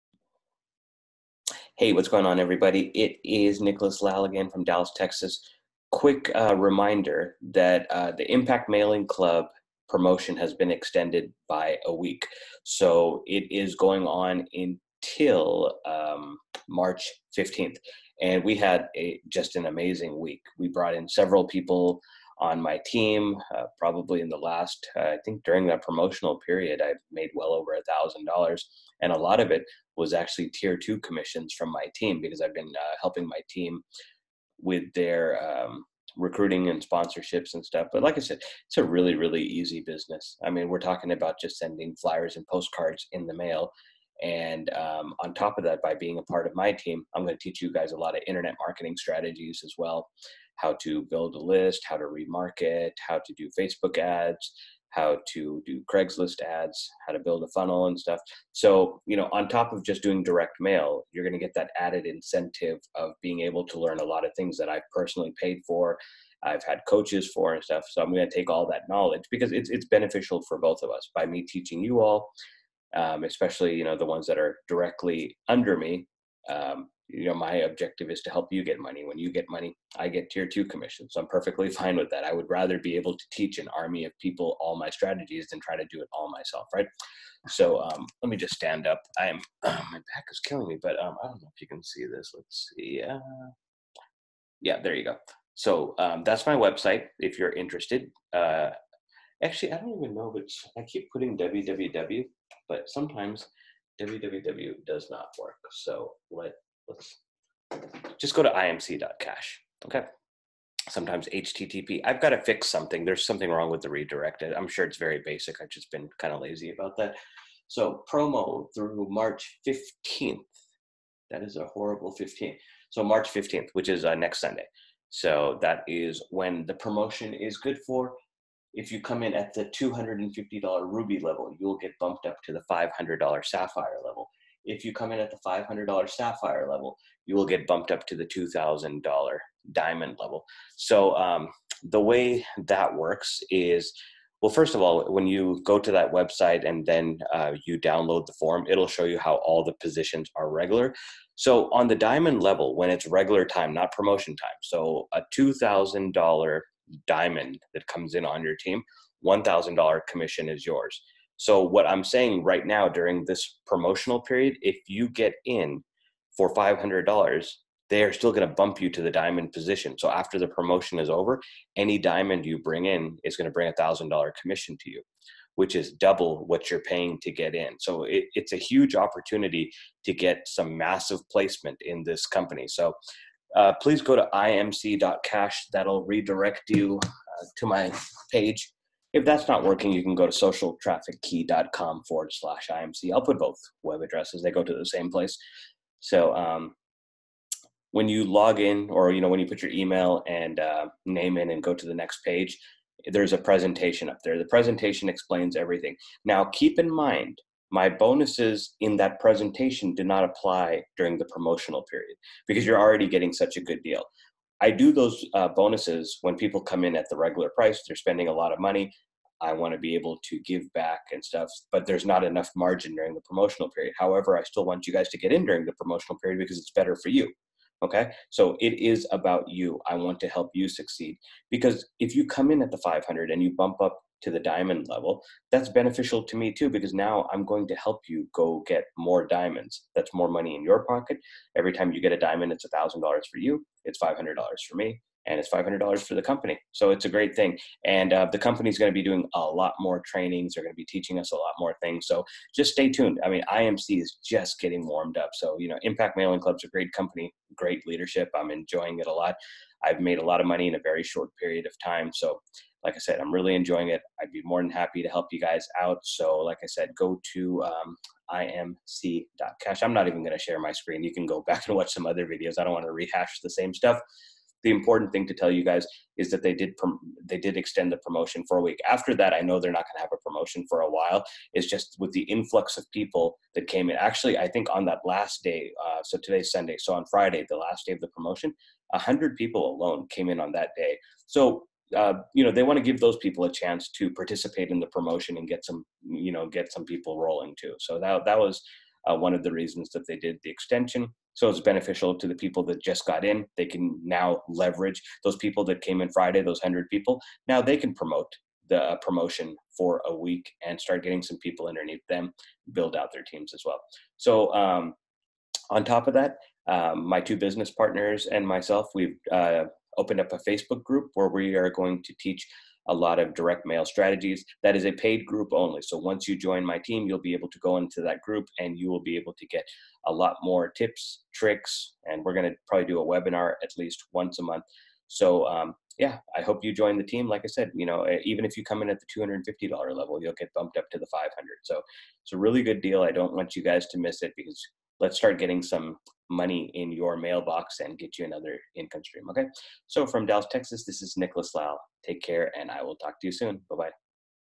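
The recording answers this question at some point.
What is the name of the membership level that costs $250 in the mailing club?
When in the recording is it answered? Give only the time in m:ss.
2:10.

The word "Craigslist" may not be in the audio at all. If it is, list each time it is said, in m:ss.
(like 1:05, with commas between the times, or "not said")
0:55.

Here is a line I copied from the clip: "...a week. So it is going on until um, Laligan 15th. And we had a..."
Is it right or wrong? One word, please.
wrong.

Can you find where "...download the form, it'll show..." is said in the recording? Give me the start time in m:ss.
2:27.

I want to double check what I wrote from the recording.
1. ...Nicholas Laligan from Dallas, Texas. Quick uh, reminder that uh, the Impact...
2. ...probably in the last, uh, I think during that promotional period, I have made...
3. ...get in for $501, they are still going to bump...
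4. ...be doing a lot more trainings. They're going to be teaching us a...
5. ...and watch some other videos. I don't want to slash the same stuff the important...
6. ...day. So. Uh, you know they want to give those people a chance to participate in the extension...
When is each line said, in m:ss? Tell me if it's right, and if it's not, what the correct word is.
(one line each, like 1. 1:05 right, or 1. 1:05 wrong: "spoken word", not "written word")
1. 0:03 right
2. 0:23 right
3. 2:45 wrong: "500", not "501"
4. 4:08 right
5. 4:31 wrong: "rehash", not "slash"
6. 4:50 wrong: "promotion", not "extension".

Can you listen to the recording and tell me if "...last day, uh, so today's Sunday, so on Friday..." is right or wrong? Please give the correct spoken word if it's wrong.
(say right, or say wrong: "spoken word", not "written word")
right.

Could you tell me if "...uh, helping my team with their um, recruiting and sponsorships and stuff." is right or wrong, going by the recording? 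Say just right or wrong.
right.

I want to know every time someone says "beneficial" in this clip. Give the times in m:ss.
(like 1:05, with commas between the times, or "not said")
1:09, 3:55, 5:01.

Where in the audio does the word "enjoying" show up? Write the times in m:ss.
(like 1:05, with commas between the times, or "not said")
4:18, 4:23.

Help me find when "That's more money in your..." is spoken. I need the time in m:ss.
3:59.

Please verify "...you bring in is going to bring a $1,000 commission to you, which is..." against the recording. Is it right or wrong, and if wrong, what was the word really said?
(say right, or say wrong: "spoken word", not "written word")
right.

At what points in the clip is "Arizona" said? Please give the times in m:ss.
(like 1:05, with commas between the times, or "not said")
not said.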